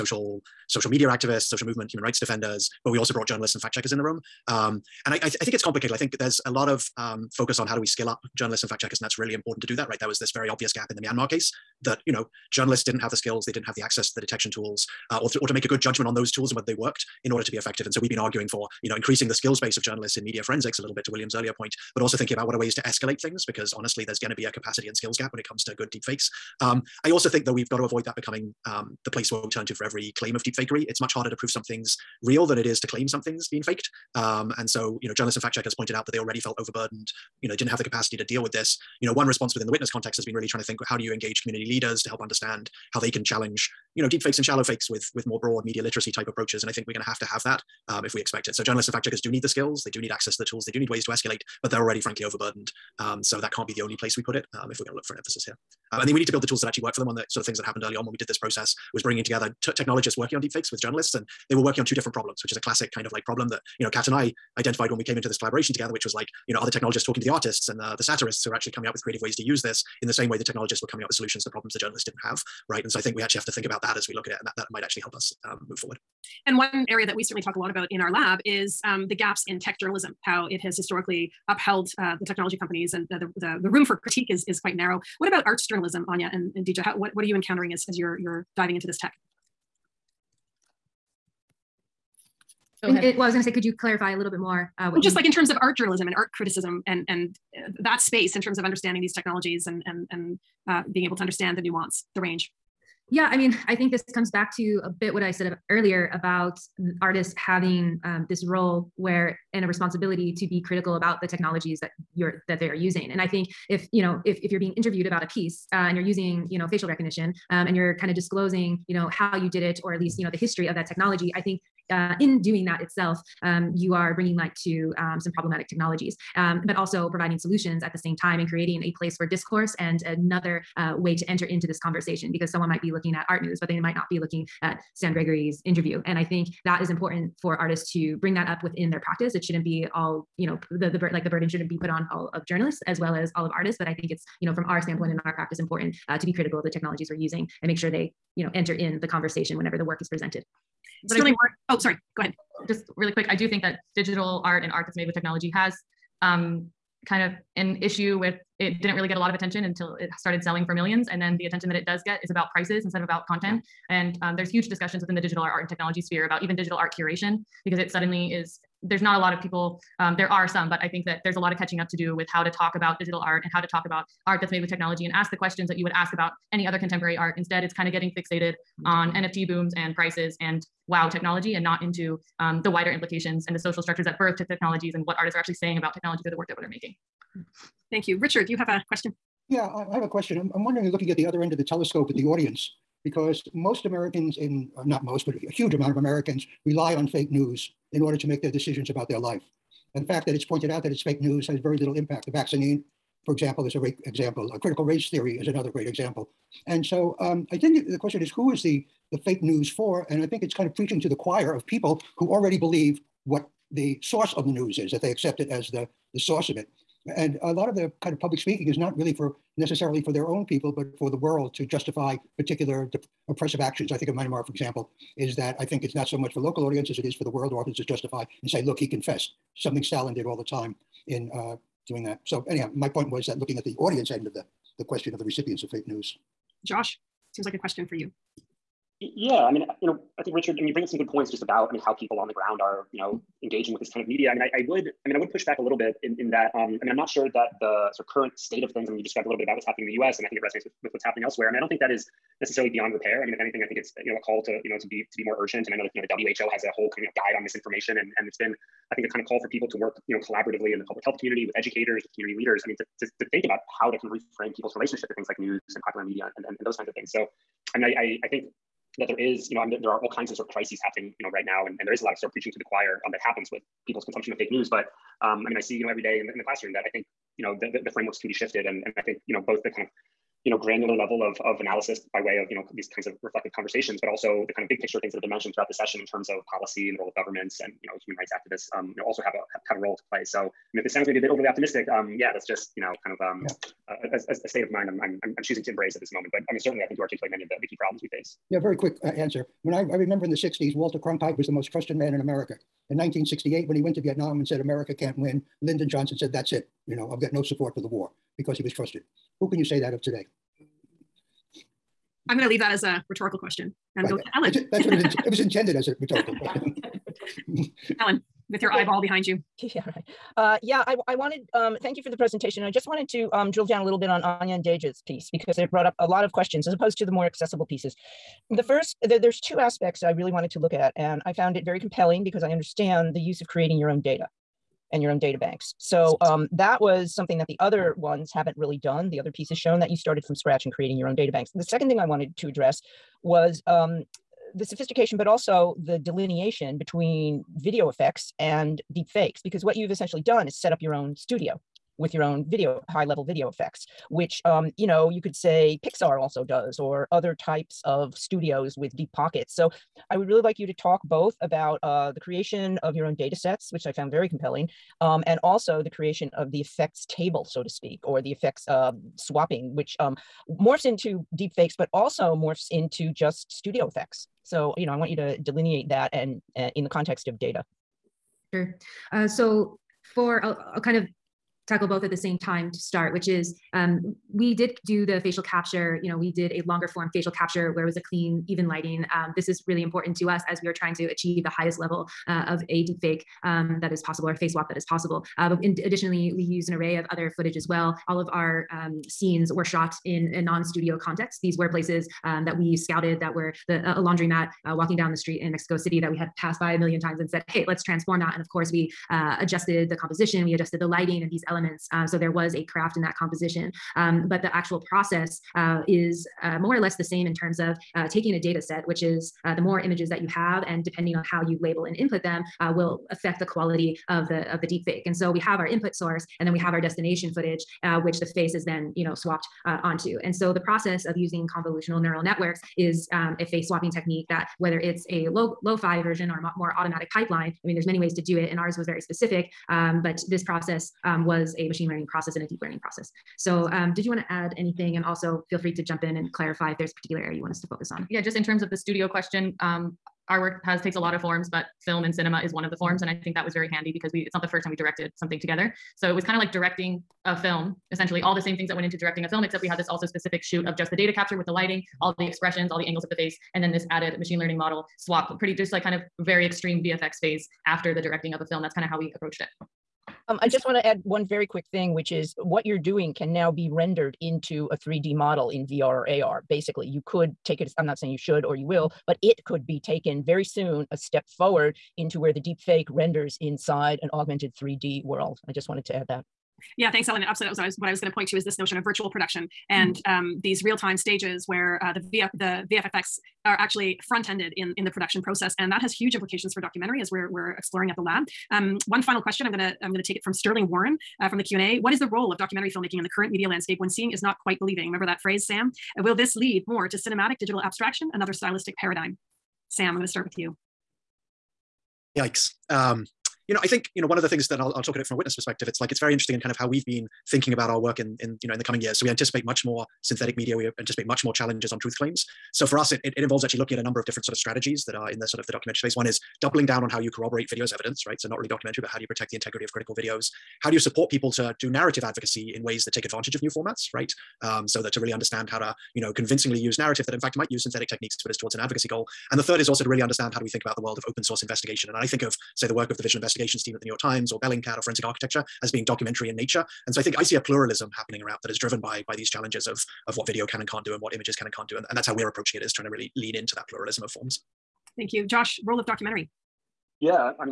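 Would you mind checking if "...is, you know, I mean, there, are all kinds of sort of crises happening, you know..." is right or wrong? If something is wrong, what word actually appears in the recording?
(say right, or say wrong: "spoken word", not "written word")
right.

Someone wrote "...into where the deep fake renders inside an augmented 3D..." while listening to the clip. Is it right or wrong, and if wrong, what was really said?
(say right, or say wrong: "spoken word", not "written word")
right.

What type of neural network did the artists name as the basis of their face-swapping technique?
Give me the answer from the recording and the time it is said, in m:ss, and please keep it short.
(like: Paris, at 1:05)
convolutional neural networks, at 7:11.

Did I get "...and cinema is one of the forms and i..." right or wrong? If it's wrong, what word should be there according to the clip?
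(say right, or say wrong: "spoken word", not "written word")
right.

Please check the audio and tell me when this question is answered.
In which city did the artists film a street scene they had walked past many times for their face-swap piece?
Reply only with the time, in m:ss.
6:45.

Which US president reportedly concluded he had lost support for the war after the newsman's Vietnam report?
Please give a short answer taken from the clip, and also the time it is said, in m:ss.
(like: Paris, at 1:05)
Lyndon Johnson, at 5:05.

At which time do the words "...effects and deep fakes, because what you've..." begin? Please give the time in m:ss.
5:47.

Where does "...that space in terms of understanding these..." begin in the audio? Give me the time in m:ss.
1:37.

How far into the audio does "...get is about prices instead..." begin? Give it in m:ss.
2:42.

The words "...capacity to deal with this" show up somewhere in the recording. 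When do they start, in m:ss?
0:37.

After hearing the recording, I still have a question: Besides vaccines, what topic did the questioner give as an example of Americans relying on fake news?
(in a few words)
critical race theory.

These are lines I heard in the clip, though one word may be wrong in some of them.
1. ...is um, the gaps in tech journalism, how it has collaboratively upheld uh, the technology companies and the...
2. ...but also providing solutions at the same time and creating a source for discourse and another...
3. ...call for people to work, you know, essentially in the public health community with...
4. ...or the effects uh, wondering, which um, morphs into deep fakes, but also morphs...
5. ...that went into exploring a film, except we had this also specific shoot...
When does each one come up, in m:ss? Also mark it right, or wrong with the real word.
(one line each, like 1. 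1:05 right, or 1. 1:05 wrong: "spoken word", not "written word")
1. 1:18 wrong: "historically", not "collaboratively"
2. 2:06 wrong: "place", not "source"
3. 4:19 wrong: "collaboratively", not "essentially"
4. 6:08 wrong: "swapping", not "wondering"
5. 7:38 wrong: "directing", not "exploring".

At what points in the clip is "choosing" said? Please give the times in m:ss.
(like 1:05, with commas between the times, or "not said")
4:55.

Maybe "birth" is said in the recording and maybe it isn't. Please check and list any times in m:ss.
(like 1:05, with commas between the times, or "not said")
3:04.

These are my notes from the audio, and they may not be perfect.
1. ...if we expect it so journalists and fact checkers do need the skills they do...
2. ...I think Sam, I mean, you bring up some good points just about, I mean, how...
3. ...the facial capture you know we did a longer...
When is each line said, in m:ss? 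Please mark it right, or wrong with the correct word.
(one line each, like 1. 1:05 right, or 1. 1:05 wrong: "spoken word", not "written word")
1. 0:48 right
2. 4:00 wrong: "Richard", not "Sam"
3. 6:25 right.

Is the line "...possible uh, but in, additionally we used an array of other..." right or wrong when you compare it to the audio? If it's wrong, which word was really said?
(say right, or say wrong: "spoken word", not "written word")
right.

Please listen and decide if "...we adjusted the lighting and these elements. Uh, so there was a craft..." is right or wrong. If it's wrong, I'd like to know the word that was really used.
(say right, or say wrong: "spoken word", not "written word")
right.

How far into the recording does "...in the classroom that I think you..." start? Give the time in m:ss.
4:36.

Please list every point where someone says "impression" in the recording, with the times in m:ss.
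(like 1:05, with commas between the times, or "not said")
not said.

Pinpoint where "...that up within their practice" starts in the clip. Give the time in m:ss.
2:18.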